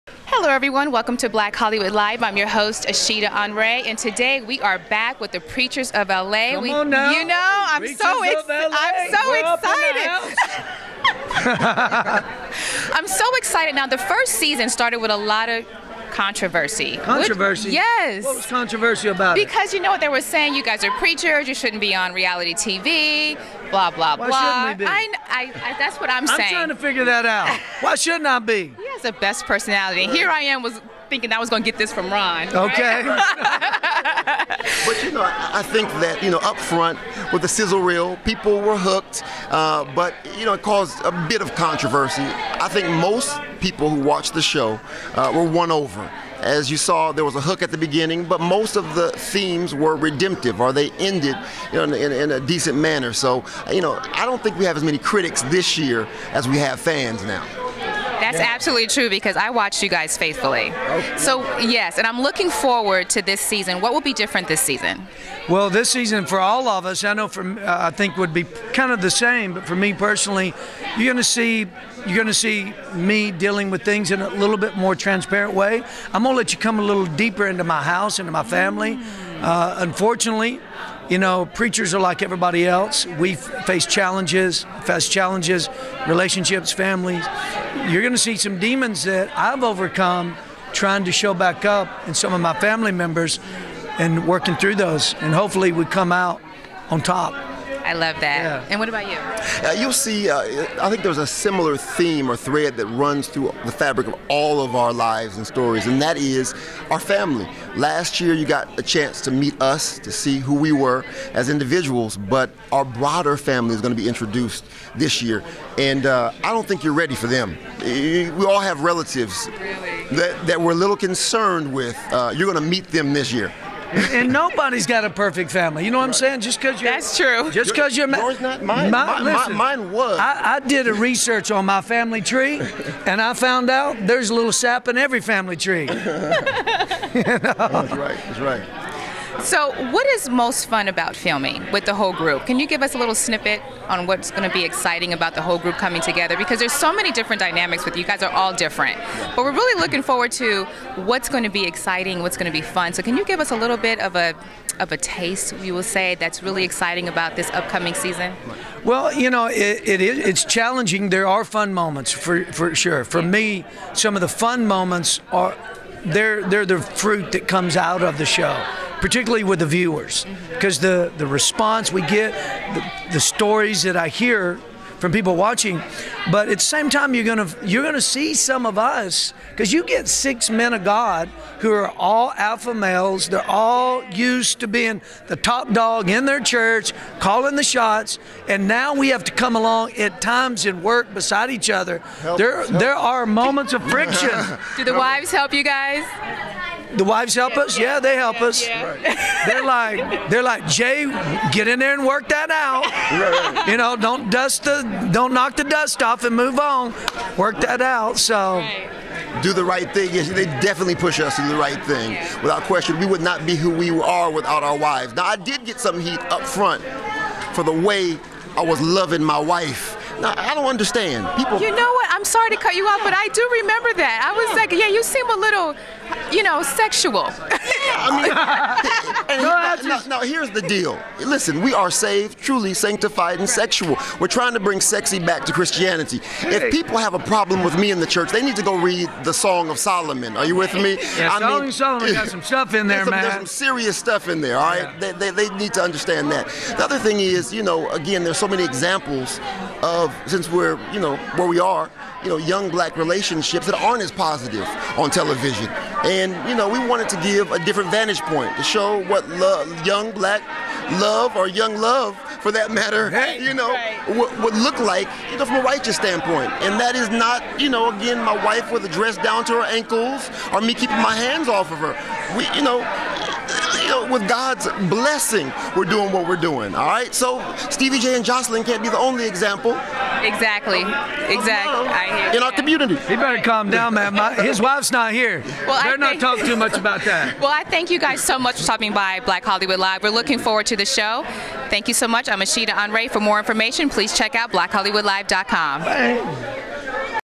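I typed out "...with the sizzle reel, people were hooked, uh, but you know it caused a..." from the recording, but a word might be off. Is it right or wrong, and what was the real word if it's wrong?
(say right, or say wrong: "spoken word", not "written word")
right.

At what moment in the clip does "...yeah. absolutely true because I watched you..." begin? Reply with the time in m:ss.
0:58.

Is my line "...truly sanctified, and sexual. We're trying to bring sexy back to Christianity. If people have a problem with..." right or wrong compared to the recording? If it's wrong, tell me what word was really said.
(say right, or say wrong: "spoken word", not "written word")
right.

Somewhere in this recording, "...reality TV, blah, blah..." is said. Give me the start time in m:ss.
0:22.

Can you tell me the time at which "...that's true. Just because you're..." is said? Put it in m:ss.
2:06.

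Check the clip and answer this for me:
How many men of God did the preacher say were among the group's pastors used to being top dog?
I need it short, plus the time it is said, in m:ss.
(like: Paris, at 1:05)
6, at 3:00.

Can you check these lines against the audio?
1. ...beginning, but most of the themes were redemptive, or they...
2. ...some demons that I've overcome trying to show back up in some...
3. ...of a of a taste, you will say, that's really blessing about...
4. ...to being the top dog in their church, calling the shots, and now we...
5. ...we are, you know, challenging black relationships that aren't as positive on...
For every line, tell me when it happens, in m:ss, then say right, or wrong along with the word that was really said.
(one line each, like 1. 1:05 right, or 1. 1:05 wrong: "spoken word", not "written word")
1. 0:47 right
2. 1:28 right
3. 2:33 wrong: "exciting", not "blessing"
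4. 3:04 right
5. 4:11 wrong: "young", not "challenging".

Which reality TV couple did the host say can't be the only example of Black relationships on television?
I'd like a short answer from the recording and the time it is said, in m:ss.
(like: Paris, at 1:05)
Stevie J and Joseline, at 4:37.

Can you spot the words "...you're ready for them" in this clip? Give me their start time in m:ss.
1:56.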